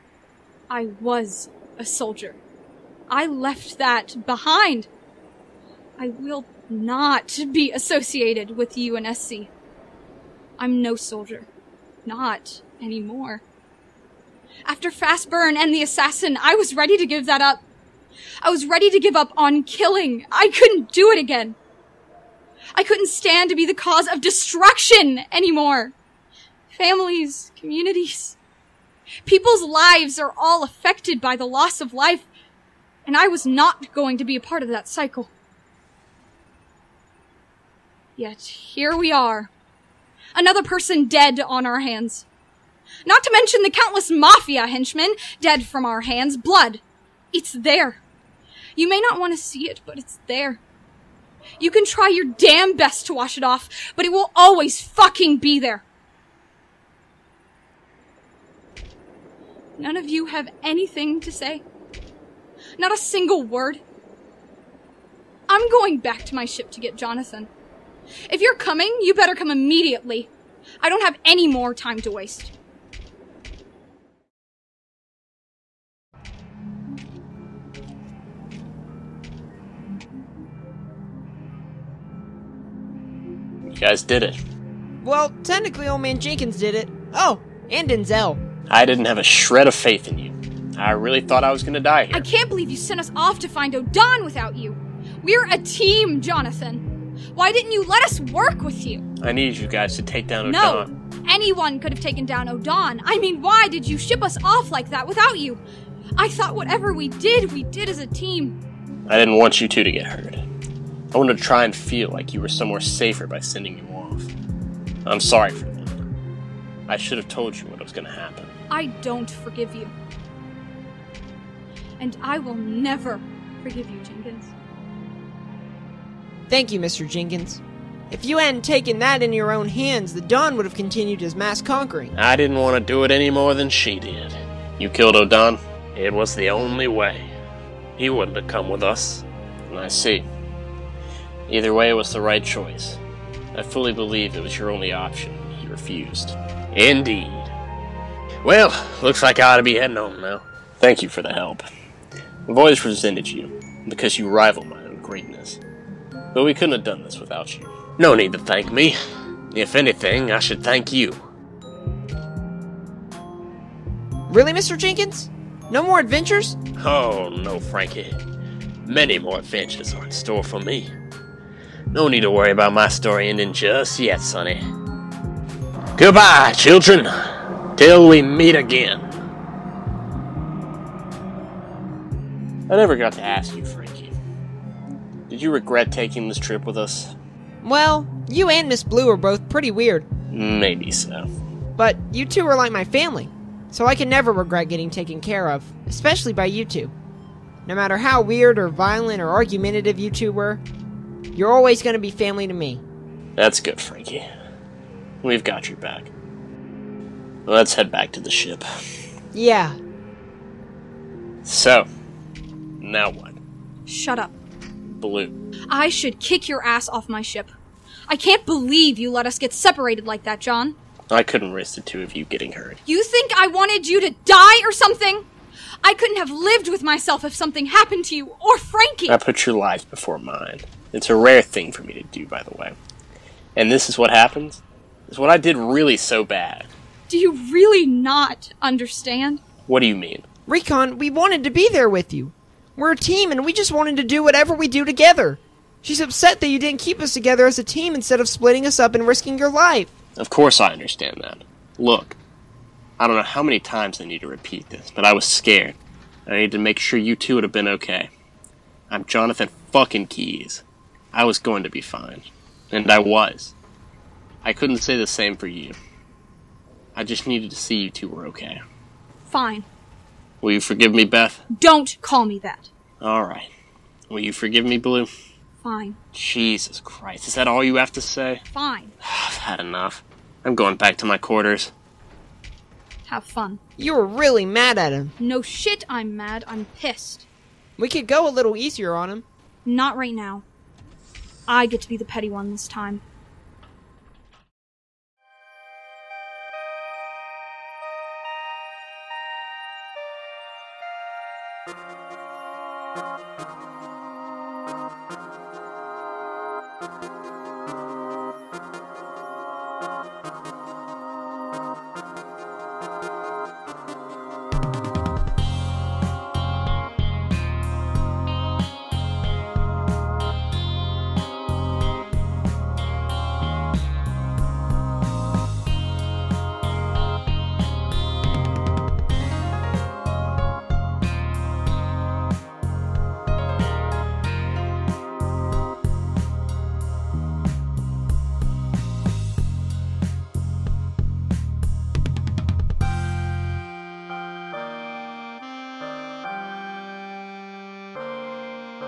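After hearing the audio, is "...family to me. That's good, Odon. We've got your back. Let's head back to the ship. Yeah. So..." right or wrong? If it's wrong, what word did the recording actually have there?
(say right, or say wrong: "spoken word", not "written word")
wrong: "Franky", not "Odon".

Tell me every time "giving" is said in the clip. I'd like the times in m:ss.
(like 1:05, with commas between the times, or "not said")
not said.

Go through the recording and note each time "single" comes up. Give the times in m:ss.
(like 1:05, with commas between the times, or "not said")
1:02.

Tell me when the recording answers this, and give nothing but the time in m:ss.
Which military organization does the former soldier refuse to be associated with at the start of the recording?
0:08.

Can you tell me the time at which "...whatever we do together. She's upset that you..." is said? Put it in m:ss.
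4:04.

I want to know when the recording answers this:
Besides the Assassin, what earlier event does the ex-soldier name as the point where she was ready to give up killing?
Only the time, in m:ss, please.
0:14.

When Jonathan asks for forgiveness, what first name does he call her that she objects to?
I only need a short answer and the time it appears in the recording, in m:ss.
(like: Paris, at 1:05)
Beth, at 4:31.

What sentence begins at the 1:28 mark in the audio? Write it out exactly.
I didn't have a shred of faith in you.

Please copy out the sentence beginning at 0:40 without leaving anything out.
Another person dead on our hands.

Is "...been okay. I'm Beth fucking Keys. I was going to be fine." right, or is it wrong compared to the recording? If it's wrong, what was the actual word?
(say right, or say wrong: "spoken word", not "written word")
wrong: "Jonathan", not "Beth".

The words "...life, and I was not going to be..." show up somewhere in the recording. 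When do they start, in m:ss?
0:31.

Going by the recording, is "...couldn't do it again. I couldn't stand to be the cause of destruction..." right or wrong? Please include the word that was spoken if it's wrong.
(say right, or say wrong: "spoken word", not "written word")
right.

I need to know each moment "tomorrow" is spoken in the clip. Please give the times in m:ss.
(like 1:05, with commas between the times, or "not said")
not said.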